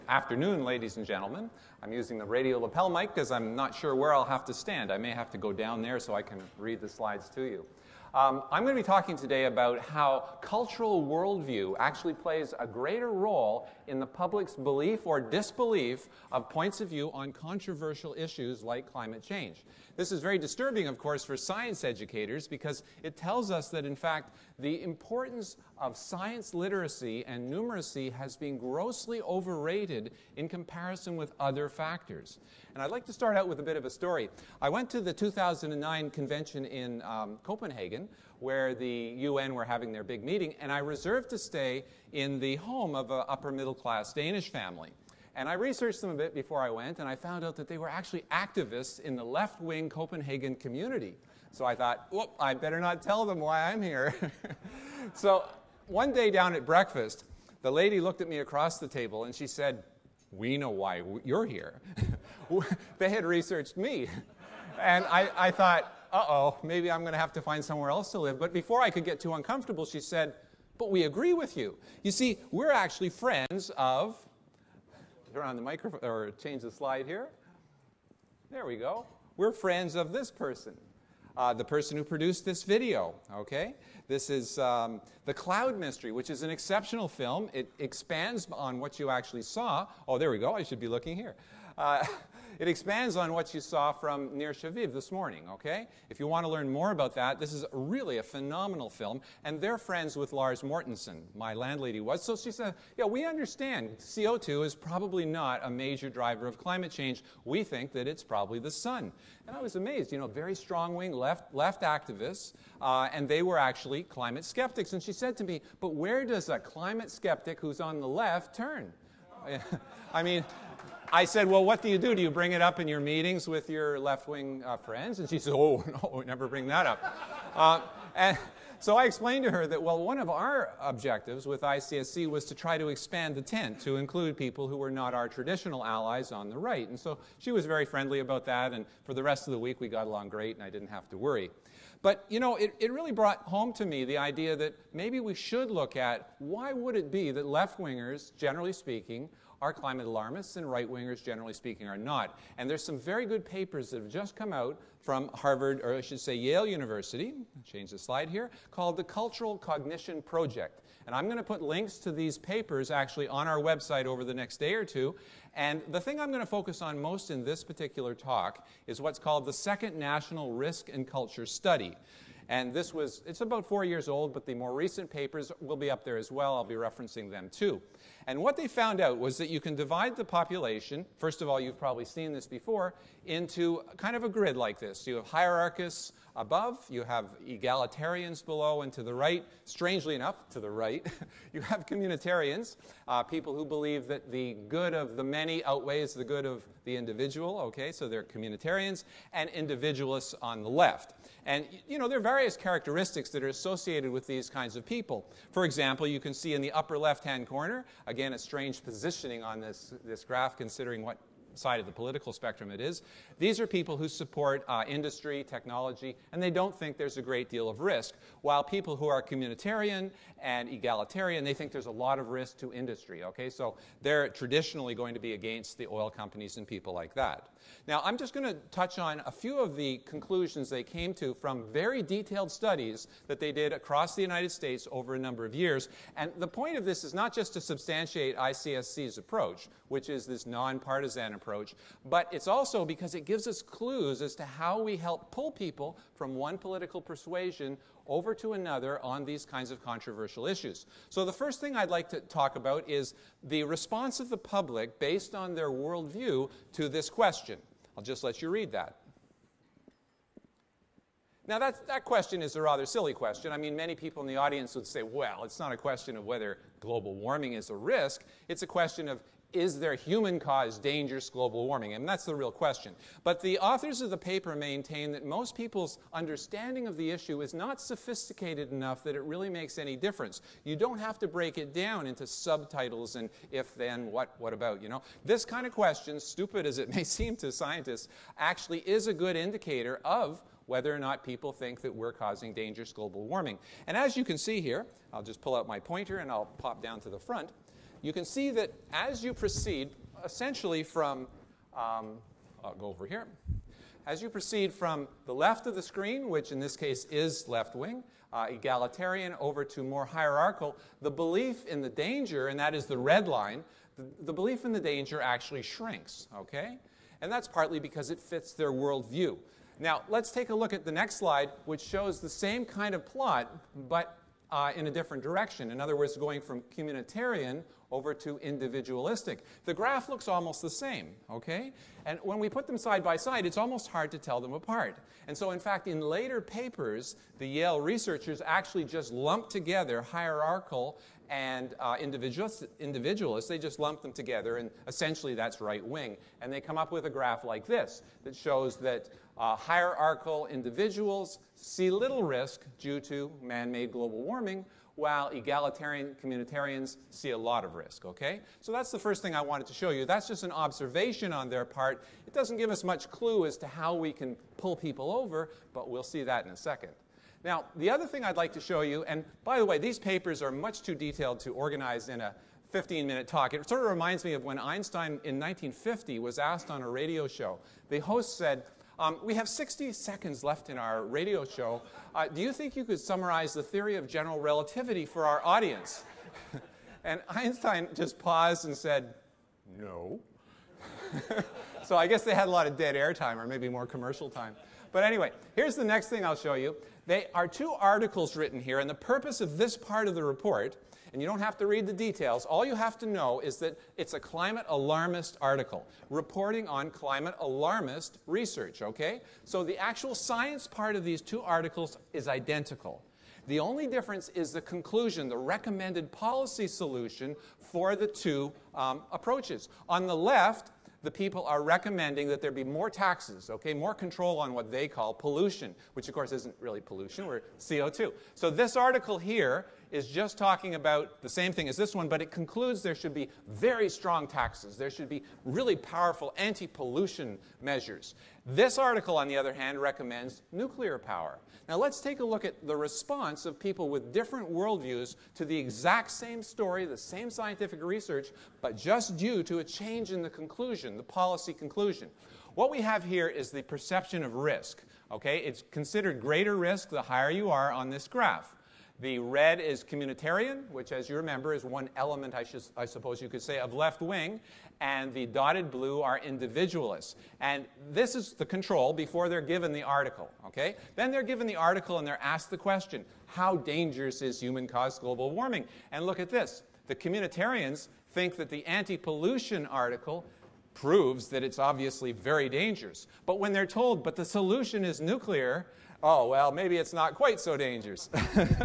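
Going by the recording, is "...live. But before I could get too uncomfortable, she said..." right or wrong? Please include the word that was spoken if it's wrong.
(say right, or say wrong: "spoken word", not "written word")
right.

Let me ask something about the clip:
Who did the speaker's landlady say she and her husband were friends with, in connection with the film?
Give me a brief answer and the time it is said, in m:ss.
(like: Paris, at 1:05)
Lars Mortensen, at 1:40.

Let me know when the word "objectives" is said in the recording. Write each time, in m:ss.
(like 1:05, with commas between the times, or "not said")
2:10.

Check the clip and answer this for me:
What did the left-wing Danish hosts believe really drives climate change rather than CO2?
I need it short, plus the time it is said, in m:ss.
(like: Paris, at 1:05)
the sun, at 1:48.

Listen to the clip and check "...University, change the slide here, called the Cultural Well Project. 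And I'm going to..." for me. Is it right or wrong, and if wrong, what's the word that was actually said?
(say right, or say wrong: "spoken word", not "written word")
wrong: "Cognition", not "Well".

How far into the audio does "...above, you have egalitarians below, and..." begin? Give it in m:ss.
3:06.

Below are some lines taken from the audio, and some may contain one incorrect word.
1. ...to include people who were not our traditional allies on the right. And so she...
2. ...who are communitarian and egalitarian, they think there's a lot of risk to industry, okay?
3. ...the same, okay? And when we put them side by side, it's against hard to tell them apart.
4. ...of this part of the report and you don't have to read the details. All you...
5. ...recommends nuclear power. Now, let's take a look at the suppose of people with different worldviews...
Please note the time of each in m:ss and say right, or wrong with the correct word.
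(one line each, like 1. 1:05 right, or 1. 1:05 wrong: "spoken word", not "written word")
1. 2:13 right
2. 3:38 right
3. 5:30 wrong: "almost", not "against"
4. 6:39 right
5. 7:19 wrong: "response", not "suppose".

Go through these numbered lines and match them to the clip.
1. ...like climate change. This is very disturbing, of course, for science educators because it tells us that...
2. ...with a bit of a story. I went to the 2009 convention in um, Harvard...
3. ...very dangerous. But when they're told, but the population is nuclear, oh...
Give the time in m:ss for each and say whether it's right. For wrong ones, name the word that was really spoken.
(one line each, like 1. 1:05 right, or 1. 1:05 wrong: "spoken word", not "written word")
1. 0:18 right
2. 0:33 wrong: "Copenhagen", not "Harvard"
3. 8:02 wrong: "solution", not "population".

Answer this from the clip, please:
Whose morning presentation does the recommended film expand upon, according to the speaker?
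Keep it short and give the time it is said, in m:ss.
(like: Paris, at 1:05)
Nir Shaviv, at 1:34.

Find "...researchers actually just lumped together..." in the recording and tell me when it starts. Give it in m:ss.
5:37.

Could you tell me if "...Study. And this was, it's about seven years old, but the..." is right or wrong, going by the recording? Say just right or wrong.
wrong.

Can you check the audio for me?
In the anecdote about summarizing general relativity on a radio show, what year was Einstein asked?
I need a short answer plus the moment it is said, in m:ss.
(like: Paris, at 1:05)
1950, at 6:15.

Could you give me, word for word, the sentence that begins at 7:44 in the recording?
And the dotted blue are individualists.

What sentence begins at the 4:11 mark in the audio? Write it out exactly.
So, the first thing I'd like to talk about is the response of the public based on their worldview to this question.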